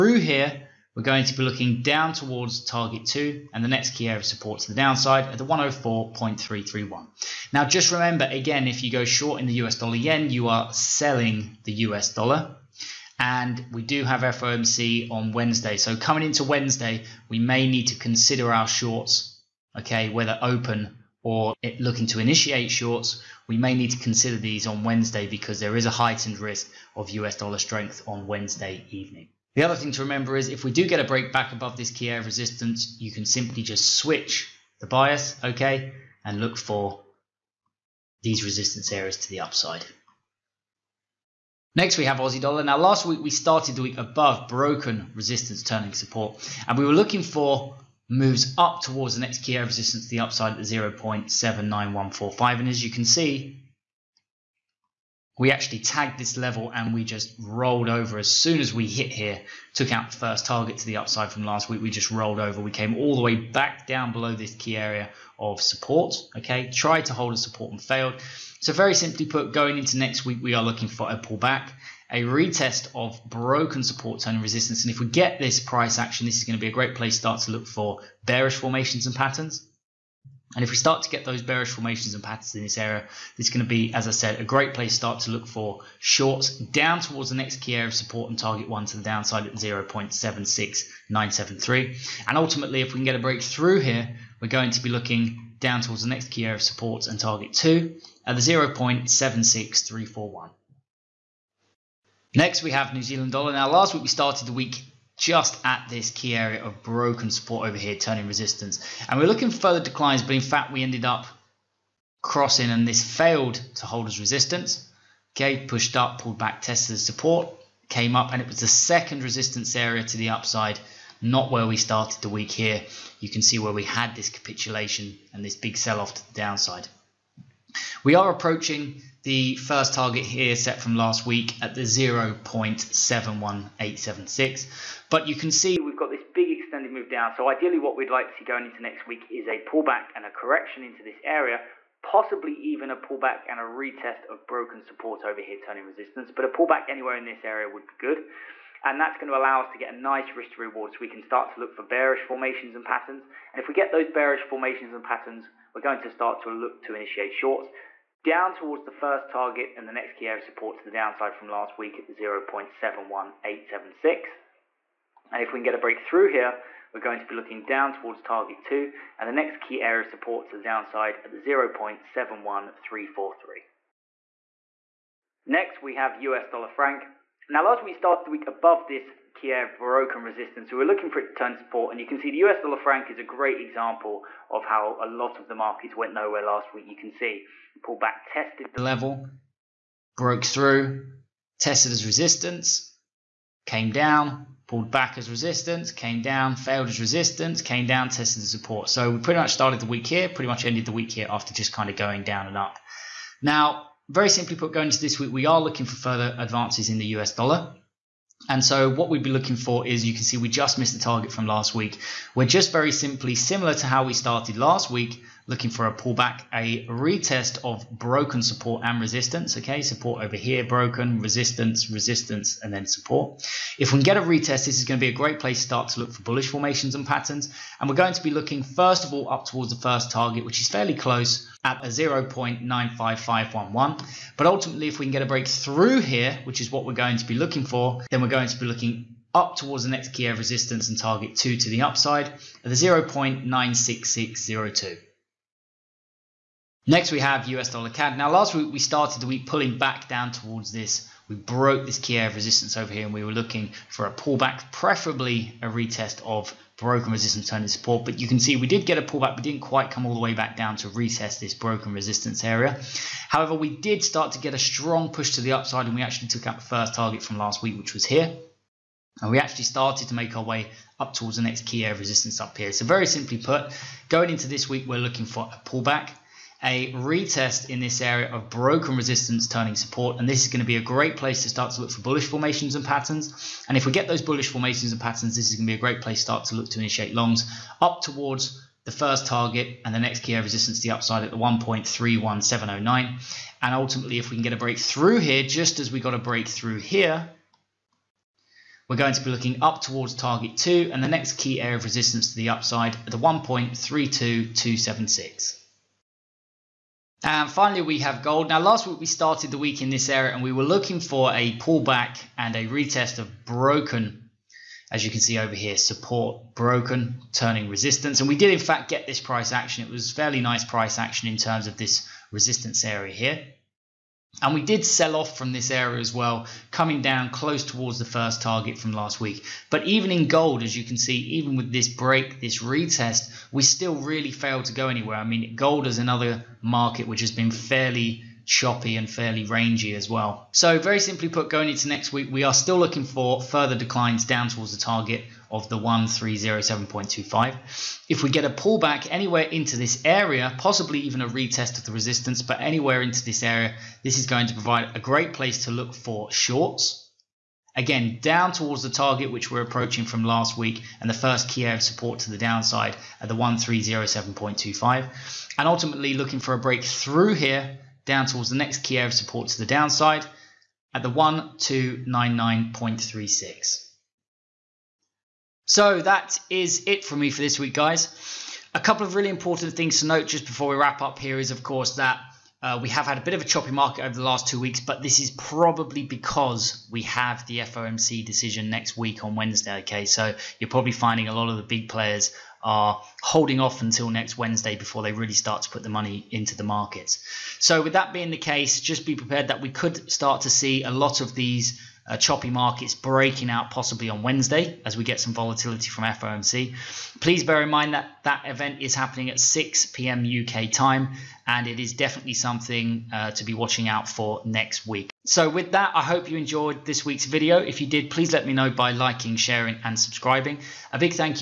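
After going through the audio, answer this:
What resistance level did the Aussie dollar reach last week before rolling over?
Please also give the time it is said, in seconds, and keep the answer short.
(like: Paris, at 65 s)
0.79145, at 50 s.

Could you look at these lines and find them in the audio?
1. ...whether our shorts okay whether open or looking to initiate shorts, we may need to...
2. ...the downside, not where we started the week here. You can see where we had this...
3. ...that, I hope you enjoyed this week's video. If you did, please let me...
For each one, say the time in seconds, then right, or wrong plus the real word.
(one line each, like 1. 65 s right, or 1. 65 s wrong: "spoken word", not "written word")
1. 17 s wrong: "consider", not "whether"
2. 120 s wrong: "upside", not "downside"
3. 415 s right.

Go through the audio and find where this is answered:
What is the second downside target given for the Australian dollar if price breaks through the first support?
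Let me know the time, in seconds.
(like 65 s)
98 s.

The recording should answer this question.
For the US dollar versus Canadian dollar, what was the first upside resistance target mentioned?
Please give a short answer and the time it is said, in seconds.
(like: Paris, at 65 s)
1.31709, at 291 s.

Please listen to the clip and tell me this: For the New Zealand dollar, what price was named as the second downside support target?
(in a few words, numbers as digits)
0.71343.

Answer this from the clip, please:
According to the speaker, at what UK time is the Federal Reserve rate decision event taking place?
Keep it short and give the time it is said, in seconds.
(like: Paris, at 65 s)
6 p.m., at 409 s.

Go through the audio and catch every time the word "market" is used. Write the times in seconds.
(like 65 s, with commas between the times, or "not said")
185 s, 336 s, 383 s, 396 s, 402 s.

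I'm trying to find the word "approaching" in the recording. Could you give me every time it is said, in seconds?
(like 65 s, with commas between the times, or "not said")
128 s, 359 s.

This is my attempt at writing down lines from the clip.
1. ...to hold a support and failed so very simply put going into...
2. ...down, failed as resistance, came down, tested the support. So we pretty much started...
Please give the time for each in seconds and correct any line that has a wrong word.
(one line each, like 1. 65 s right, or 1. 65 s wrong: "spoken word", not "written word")
1. 67 s right
2. 196 s right.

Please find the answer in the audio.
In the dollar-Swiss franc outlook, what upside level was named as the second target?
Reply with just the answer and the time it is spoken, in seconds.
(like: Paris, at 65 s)
0.96602, at 242 s.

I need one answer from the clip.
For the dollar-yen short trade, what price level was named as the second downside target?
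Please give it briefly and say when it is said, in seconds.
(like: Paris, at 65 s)
104.331, at 5 s.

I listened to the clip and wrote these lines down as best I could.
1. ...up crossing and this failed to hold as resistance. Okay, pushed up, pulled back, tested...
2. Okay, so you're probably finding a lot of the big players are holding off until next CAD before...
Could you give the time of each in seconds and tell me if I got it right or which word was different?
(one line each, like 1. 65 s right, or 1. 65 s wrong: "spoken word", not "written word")
1. 111 s right
2. 389 s wrong: "Wednesday", not "CAD".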